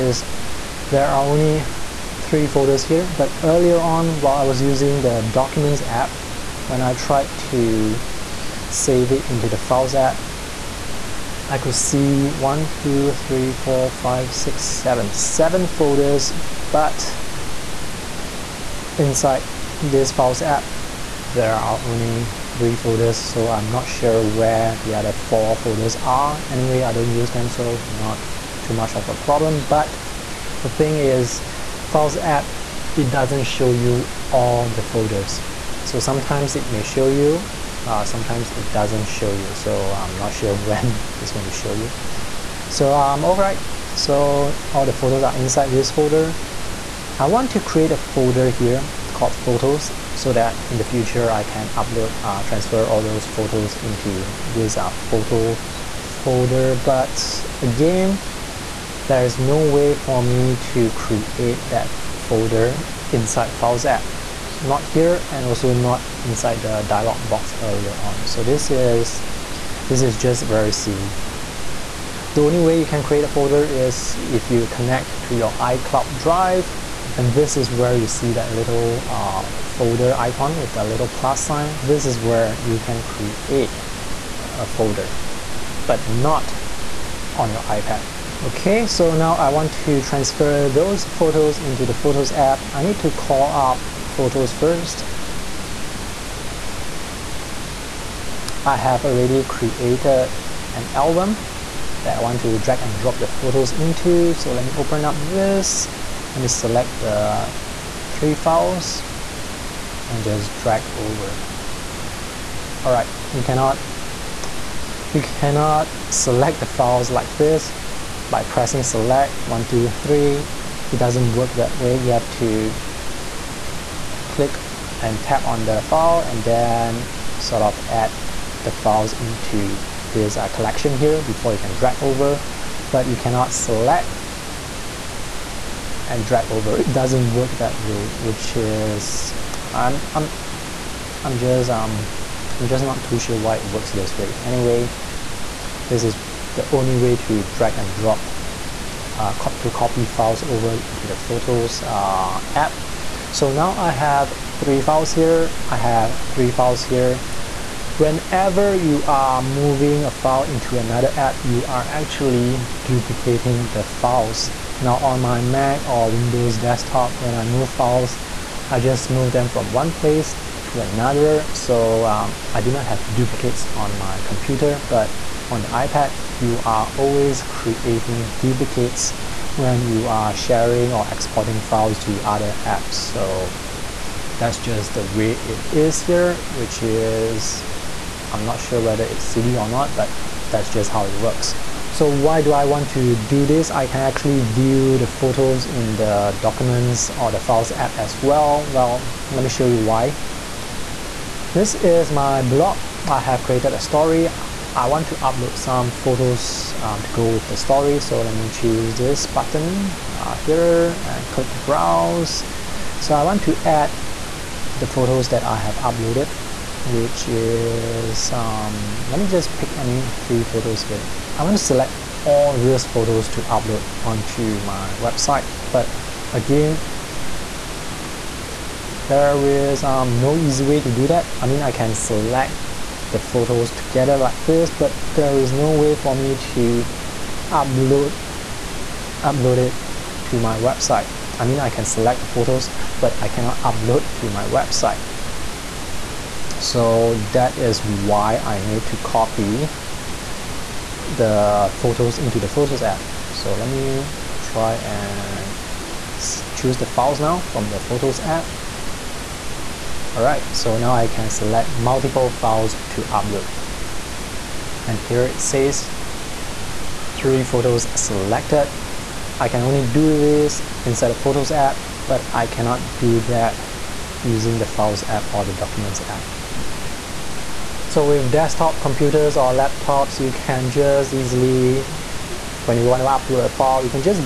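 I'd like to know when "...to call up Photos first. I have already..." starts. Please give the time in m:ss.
1:32.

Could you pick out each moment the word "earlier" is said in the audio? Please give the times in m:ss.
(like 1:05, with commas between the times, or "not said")
0:03, 1:07.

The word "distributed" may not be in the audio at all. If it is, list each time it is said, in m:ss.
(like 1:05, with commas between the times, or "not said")
not said.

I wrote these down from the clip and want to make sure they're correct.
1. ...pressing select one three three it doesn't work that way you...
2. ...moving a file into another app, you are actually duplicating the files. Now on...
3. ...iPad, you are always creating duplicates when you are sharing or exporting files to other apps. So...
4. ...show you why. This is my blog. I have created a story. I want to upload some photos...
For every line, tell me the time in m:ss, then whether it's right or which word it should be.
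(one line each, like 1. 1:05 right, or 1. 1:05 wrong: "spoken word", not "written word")
1. 1:58 wrong: "two", not "three"
2. 2:39 right
3. 2:55 right
4. 3:19 right.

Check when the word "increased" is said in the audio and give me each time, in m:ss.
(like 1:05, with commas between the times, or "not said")
not said.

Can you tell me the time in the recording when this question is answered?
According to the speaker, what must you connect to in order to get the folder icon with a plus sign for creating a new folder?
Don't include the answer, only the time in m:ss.
1:15.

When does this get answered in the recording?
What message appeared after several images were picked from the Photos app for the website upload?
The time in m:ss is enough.
4:27.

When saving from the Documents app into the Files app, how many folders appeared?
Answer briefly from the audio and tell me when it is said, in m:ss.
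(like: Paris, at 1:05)
7, at 0:15.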